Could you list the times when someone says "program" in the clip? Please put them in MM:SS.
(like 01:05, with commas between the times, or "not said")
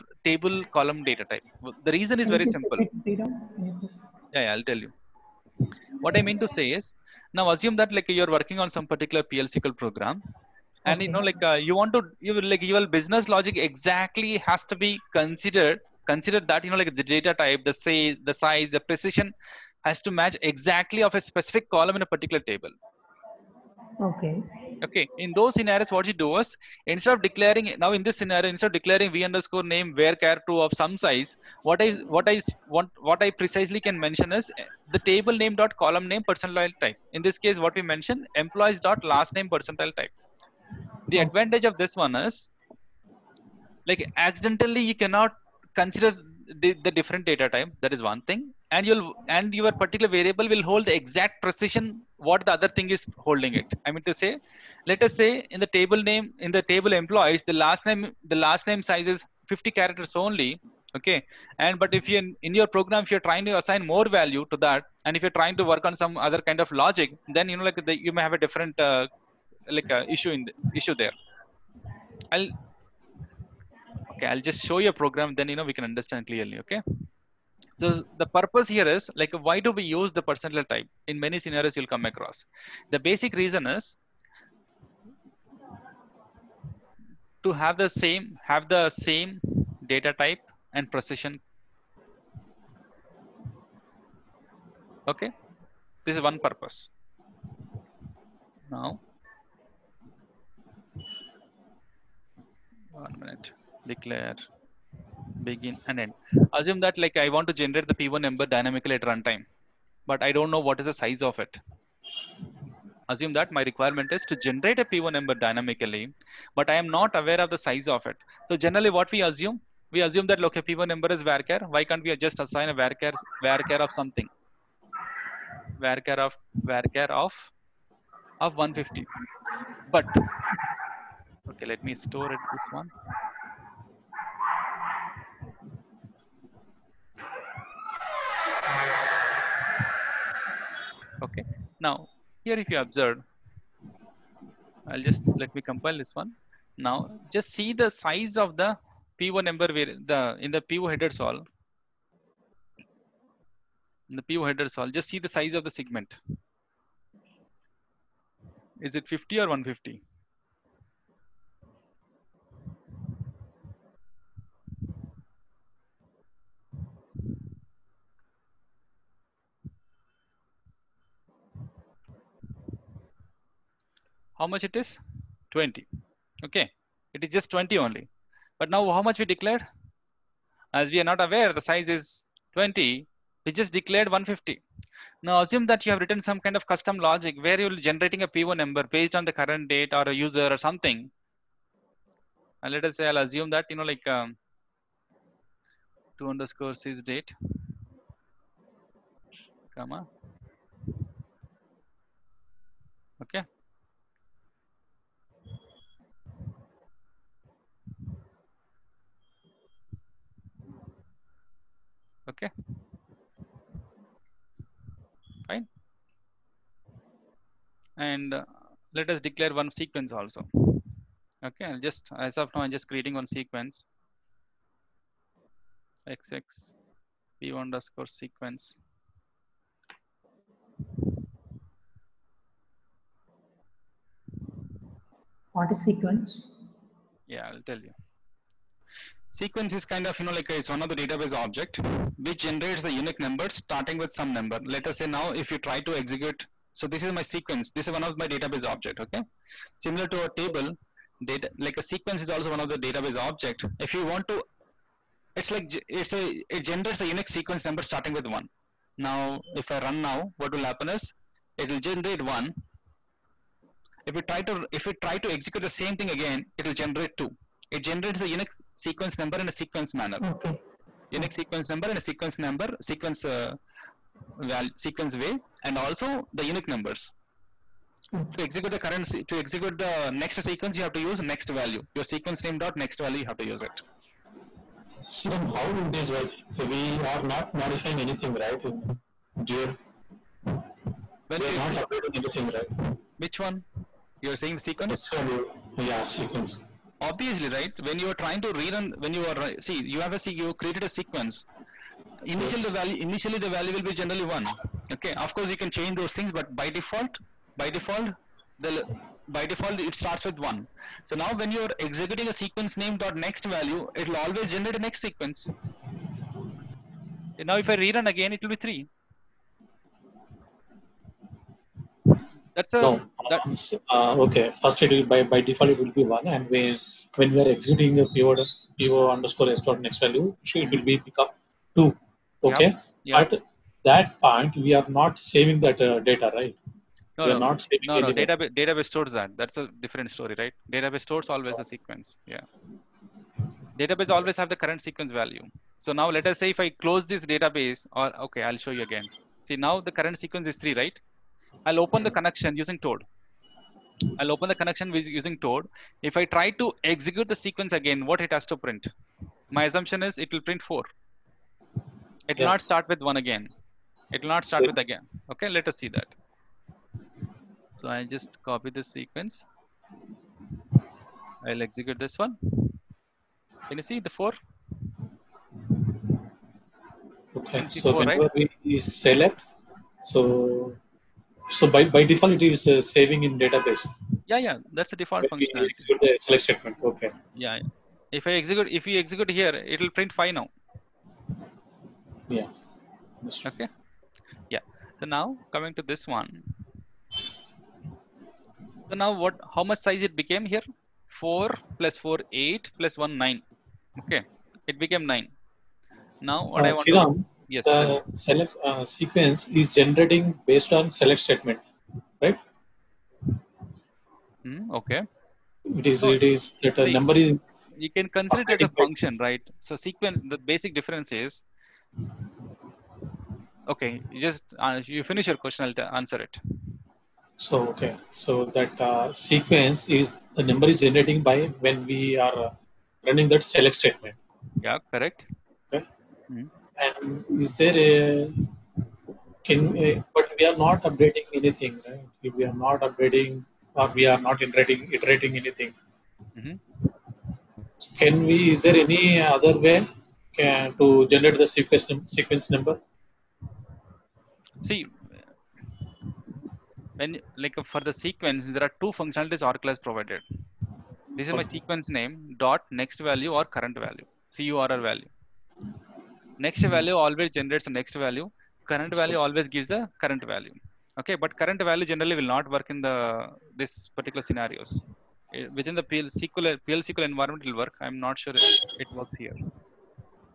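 00:09, 01:02, 01:14.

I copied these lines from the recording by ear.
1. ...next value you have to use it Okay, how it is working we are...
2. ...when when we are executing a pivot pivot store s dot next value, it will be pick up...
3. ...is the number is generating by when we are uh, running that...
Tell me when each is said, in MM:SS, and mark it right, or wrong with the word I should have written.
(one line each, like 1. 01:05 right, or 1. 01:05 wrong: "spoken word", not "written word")
1. 04:42 wrong: "Siram", not "Okay"
2. 05:26 wrong: "underscore", not "store"
3. 07:09 right.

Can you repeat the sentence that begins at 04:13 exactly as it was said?
If you want to, it's like, it's a it generates a unique sequence number starting with one.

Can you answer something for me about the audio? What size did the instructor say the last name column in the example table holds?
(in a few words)
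50 characters.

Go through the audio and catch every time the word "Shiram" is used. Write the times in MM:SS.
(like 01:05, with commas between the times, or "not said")
06:46.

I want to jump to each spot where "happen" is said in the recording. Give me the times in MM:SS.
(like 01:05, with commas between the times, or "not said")
04:20.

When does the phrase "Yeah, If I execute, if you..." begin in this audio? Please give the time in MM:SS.
06:27.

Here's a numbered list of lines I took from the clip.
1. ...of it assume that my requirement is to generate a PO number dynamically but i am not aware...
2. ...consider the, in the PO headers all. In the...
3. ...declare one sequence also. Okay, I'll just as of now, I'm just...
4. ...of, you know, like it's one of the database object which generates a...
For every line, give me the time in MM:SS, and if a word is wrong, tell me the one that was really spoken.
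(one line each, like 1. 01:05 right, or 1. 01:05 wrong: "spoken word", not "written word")
1. 01:51 right
2. 02:29 wrong: "number", not "consider"
3. 03:39 right
4. 04:00 right.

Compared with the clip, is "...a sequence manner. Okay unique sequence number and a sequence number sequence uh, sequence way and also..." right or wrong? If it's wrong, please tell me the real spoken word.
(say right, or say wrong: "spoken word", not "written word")
right.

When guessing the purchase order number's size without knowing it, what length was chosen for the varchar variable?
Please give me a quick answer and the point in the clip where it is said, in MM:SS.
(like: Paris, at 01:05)
150, at 02:06.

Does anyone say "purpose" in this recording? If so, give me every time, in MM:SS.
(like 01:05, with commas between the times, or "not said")
01:18, 01:36.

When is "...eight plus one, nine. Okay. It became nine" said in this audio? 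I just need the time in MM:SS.
06:42.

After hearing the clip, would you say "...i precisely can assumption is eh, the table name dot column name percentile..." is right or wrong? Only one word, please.
wrong.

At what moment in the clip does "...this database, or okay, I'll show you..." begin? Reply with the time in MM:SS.
05:47.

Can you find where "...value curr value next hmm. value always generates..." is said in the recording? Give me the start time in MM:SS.
07:43.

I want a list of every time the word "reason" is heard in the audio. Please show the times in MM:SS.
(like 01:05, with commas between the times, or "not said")
00:01, 01:23.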